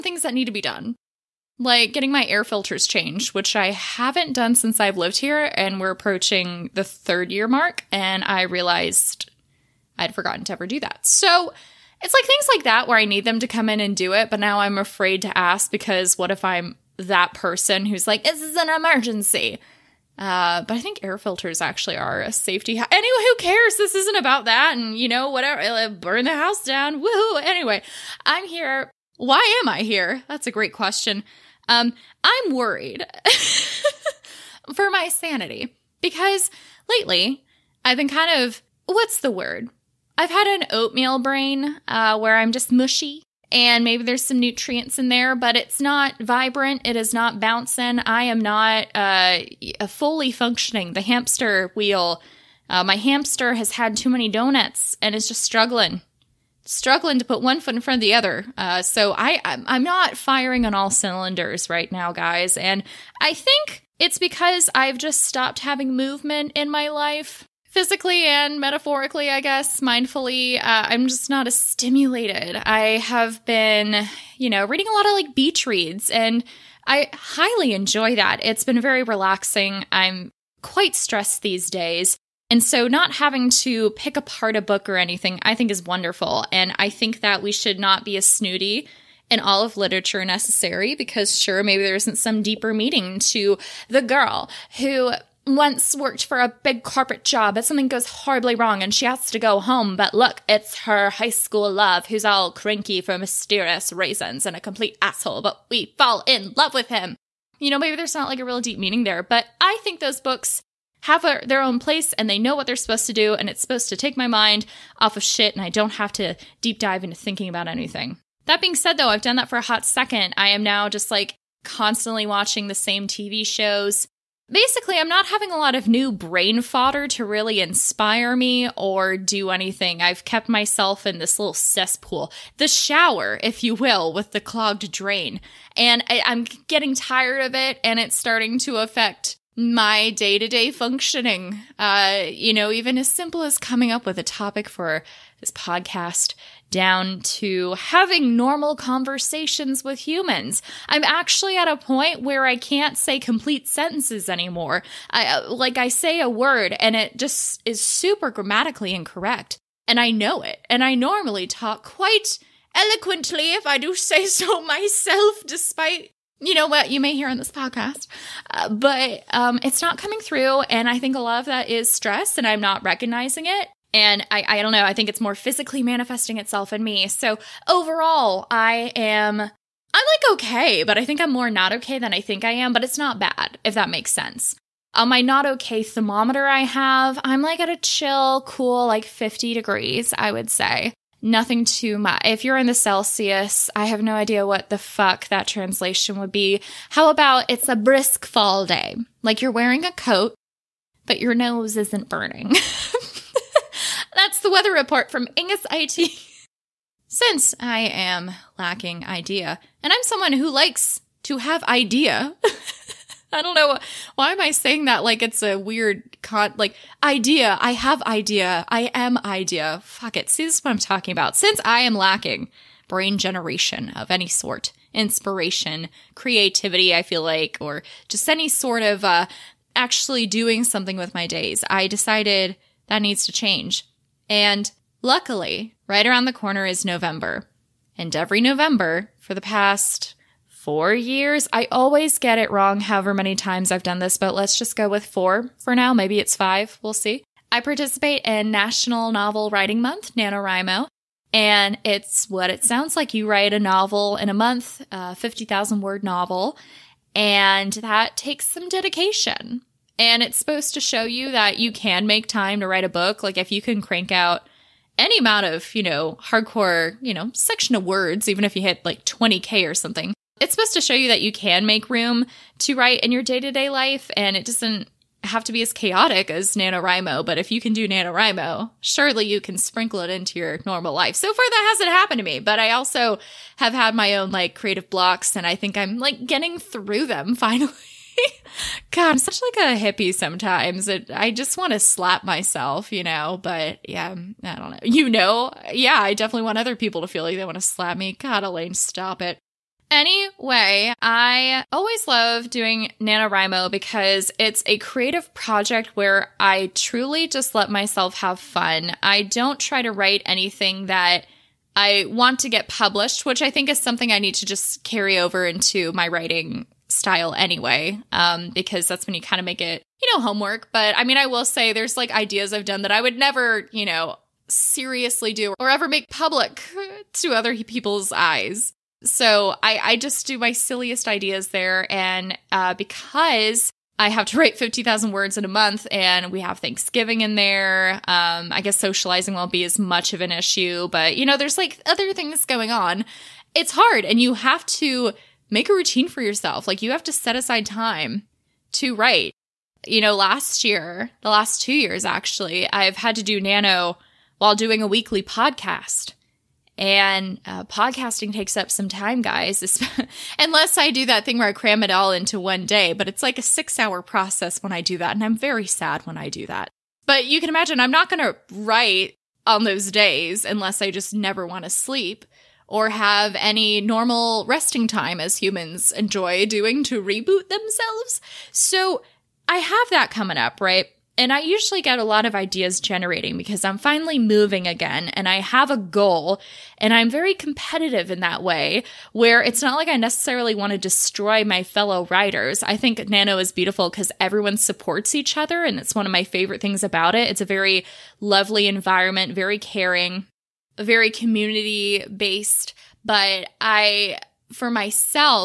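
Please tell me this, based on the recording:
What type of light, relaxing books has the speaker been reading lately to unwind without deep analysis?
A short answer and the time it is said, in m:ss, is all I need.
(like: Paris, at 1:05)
beach reads, at 1:15.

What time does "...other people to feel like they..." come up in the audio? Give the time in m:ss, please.
4:56.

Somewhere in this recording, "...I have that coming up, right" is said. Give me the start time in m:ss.
6:19.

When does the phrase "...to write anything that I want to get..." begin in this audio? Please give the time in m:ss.
5:09.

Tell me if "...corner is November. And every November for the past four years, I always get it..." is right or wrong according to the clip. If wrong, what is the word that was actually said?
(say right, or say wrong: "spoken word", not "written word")
right.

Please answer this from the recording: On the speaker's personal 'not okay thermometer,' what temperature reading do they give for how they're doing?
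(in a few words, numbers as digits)
50 degrees.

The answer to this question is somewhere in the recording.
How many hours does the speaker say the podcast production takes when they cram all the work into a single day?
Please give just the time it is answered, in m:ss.
6:03.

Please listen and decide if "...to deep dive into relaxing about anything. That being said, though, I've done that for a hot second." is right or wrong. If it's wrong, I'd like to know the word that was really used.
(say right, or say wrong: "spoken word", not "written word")
wrong: "thinking", not "relaxing".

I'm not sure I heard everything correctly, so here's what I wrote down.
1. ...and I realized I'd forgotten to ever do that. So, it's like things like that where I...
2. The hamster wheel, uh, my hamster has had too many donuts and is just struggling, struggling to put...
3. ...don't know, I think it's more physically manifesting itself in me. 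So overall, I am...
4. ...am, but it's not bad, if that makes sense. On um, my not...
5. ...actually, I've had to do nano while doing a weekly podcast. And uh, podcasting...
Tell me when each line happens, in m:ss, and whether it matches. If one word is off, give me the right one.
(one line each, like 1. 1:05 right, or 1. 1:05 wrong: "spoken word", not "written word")
1. 0:07 right
2. 0:50 right
3. 2:54 right
4. 3:02 right
5. 5:52 right.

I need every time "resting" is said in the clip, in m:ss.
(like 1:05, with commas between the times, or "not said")
6:14.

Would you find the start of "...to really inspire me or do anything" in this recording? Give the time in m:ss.
2:07.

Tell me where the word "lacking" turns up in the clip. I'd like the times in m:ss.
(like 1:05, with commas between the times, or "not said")
3:28, 3:41.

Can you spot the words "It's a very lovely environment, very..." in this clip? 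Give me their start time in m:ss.
6:37.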